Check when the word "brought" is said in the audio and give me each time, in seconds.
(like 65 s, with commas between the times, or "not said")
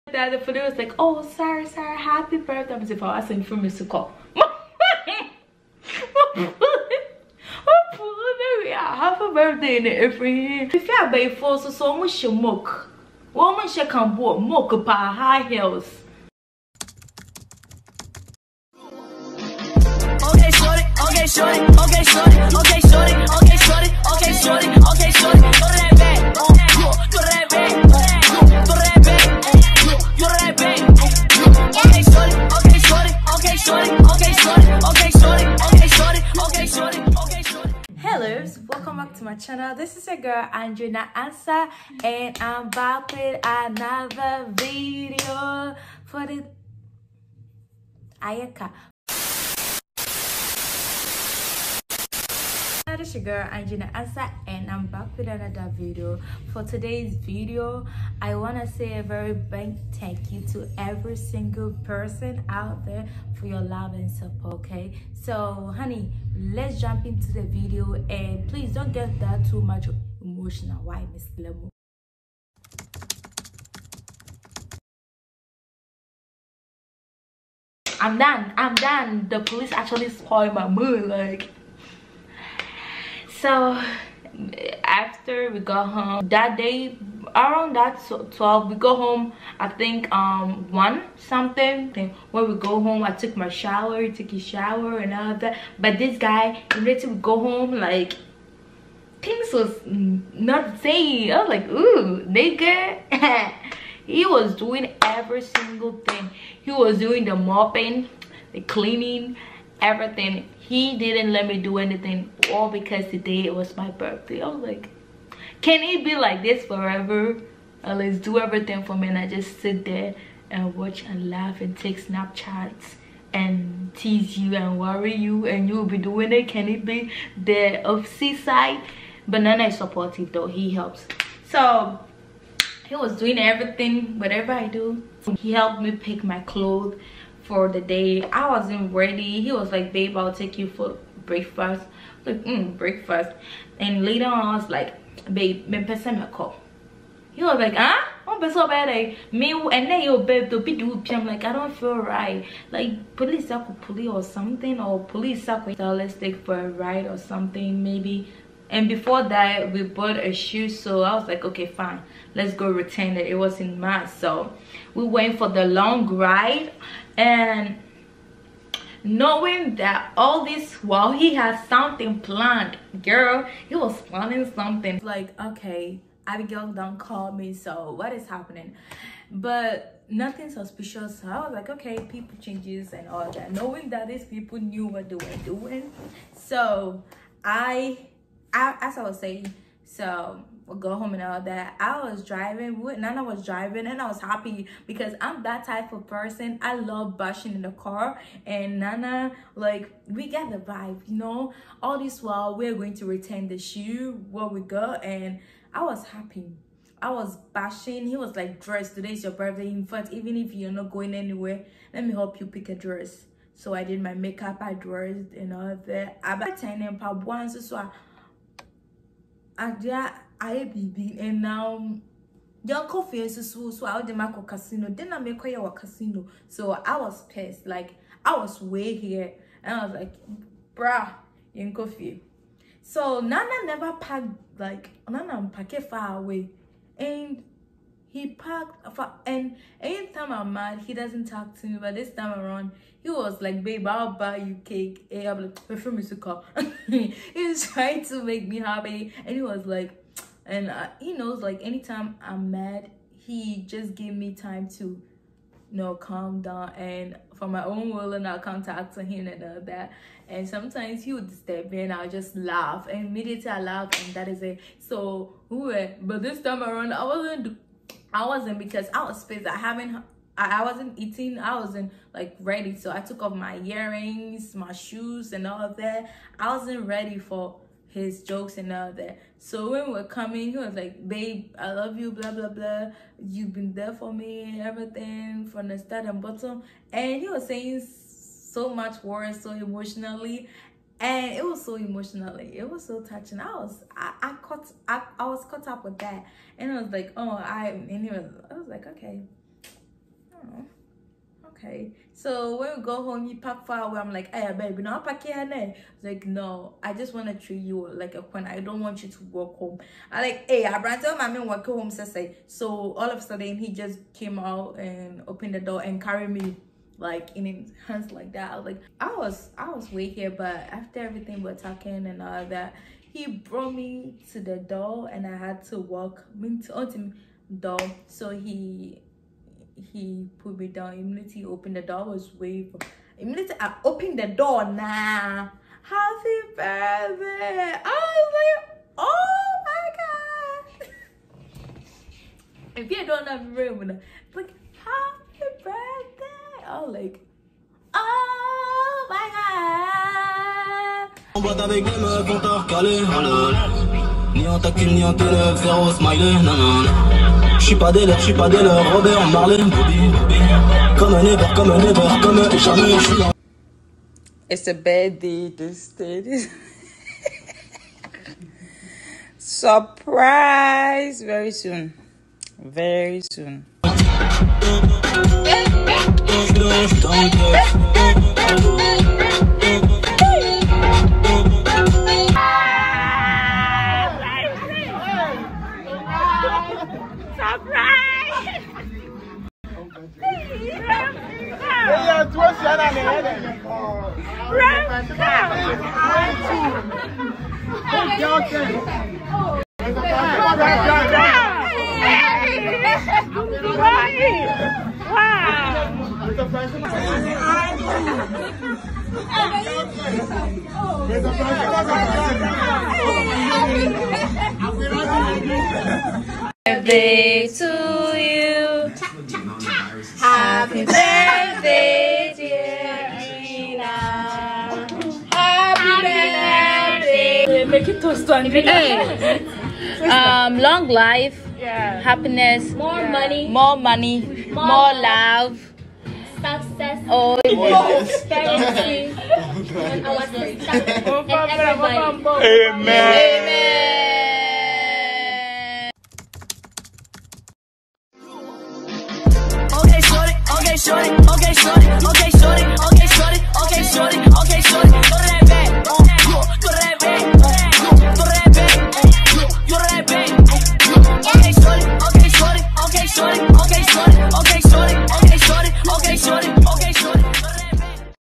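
310 s, 323 s.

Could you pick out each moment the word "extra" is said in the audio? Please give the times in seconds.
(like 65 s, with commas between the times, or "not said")
not said.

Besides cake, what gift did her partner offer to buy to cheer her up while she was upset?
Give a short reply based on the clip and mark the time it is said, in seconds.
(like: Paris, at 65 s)
Perfume, at 245 s.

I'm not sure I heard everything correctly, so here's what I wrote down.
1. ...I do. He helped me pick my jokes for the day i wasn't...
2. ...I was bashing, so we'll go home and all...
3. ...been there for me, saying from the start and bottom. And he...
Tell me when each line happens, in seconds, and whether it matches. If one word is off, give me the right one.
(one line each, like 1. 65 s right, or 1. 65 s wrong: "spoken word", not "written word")
1. 134 s wrong: "clothes", not "jokes"
2. 188 s wrong: "saying", not "bashing"
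3. 283 s wrong: "everything", not "saying".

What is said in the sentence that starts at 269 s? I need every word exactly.
I haven't I wasn't eating, I wasn't like ready.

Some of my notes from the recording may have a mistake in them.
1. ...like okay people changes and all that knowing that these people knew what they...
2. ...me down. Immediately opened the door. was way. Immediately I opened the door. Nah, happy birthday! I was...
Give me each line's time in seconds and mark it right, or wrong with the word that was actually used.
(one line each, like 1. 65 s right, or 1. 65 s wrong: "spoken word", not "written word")
1. 181 s right
2. 330 s right.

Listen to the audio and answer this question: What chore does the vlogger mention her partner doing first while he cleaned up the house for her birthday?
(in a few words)
Mopping.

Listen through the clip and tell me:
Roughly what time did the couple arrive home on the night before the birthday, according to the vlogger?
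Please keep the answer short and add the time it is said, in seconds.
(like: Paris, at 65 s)
1, at 90 s.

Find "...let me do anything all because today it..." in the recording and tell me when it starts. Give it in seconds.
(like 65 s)
111 s.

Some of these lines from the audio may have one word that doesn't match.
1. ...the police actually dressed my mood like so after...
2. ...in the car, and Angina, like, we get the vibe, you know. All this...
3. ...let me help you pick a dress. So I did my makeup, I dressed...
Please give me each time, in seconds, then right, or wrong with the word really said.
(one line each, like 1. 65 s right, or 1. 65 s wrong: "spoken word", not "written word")
1. 79 s wrong: "spoiled", not "dressed"
2. 197 s wrong: "Nana", not "Angina"
3. 211 s right.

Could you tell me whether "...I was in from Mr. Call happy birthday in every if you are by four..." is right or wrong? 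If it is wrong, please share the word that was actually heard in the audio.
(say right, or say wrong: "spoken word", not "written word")
right.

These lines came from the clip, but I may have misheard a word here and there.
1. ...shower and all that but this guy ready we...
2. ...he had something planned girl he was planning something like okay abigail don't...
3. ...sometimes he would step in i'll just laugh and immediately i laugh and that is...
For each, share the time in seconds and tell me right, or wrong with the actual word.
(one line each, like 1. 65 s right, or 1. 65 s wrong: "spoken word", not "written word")
1. 94 s right
2. 171 s right
3. 260 s right.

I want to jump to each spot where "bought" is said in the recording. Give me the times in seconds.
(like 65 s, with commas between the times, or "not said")
159 s, 216 s.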